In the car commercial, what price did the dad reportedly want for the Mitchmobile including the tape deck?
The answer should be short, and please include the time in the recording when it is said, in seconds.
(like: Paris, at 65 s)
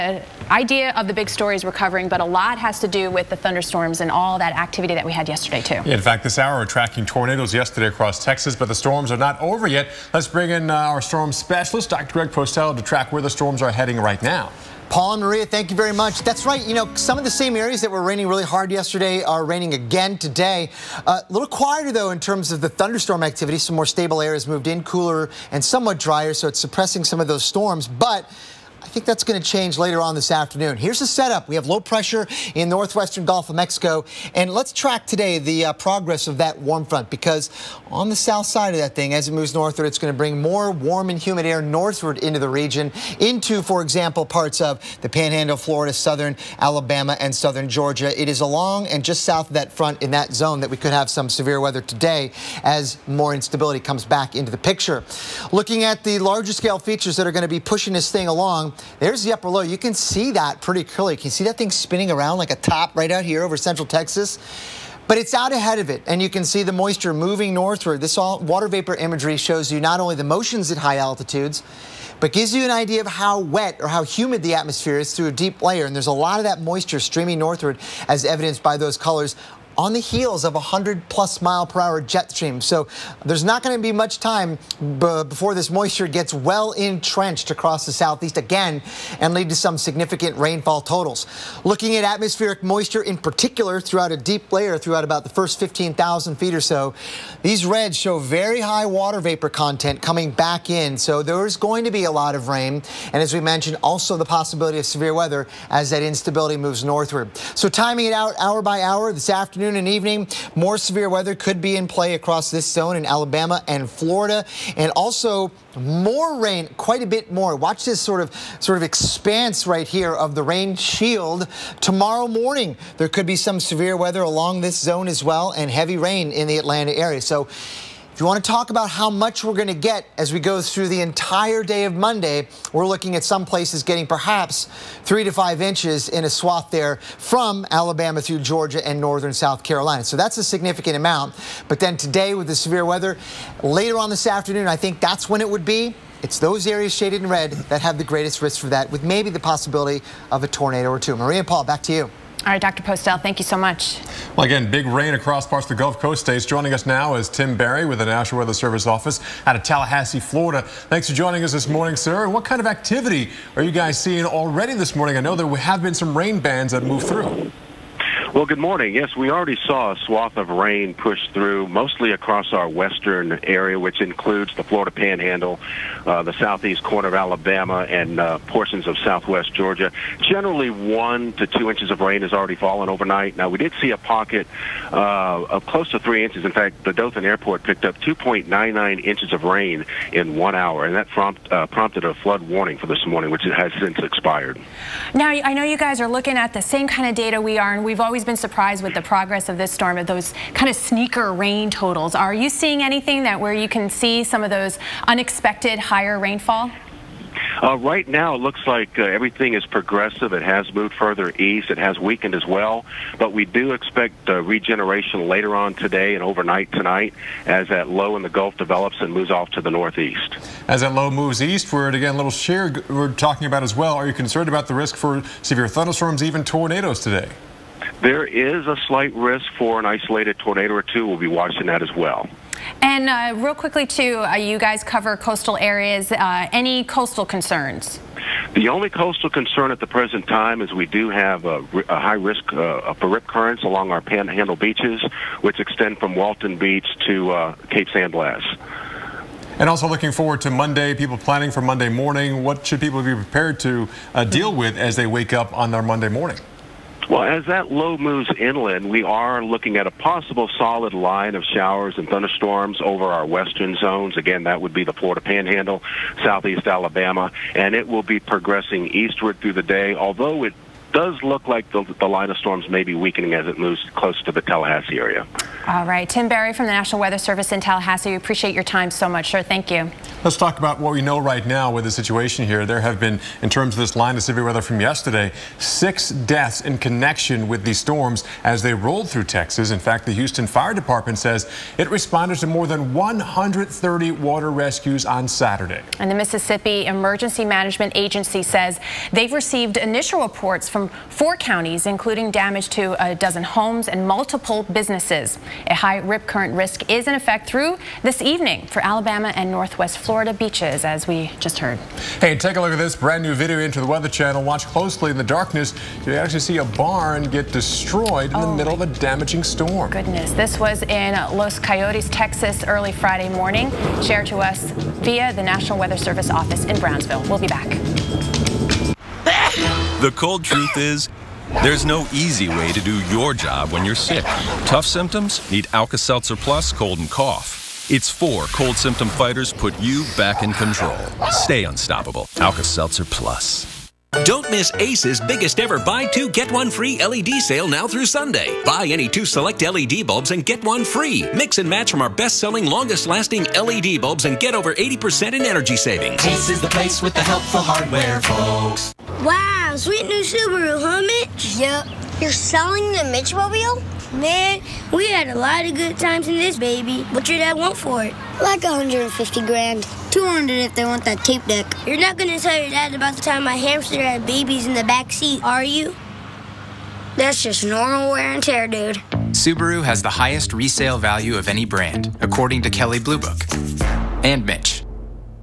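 200 grand, at 370 s.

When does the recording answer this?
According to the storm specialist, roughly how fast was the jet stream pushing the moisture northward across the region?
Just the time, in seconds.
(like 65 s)
80 s.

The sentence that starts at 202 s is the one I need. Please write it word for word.
Are you seeing anything that where you can see some of those unexpected higher rainfall?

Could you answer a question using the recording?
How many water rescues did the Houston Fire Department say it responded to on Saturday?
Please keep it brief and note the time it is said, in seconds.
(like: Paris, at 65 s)
More than 130, at 292 s.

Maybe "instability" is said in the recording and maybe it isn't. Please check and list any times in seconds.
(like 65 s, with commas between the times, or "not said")
53 s, 106 s.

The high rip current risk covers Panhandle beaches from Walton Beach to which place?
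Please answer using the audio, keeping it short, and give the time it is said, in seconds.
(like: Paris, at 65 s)
Cape San Blas, at 247 s.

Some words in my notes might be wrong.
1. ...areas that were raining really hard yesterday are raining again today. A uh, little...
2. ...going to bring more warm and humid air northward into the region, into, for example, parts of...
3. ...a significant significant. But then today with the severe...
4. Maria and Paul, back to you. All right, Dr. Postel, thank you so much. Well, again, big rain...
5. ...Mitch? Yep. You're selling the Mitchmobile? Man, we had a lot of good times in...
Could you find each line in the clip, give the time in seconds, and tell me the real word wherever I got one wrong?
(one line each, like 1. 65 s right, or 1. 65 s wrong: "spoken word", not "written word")
1. 17 s right
2. 39 s right
3. 140 s wrong: "amount", not "significant"
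4. 151 s right
5. 361 s right.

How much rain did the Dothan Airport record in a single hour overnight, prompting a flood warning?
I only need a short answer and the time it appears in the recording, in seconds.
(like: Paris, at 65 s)
2.99 inches, at 188 s.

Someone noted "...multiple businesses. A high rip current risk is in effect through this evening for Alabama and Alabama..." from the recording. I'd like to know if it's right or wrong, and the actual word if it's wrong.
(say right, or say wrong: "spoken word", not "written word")
wrong: "Northwest", not "Alabama".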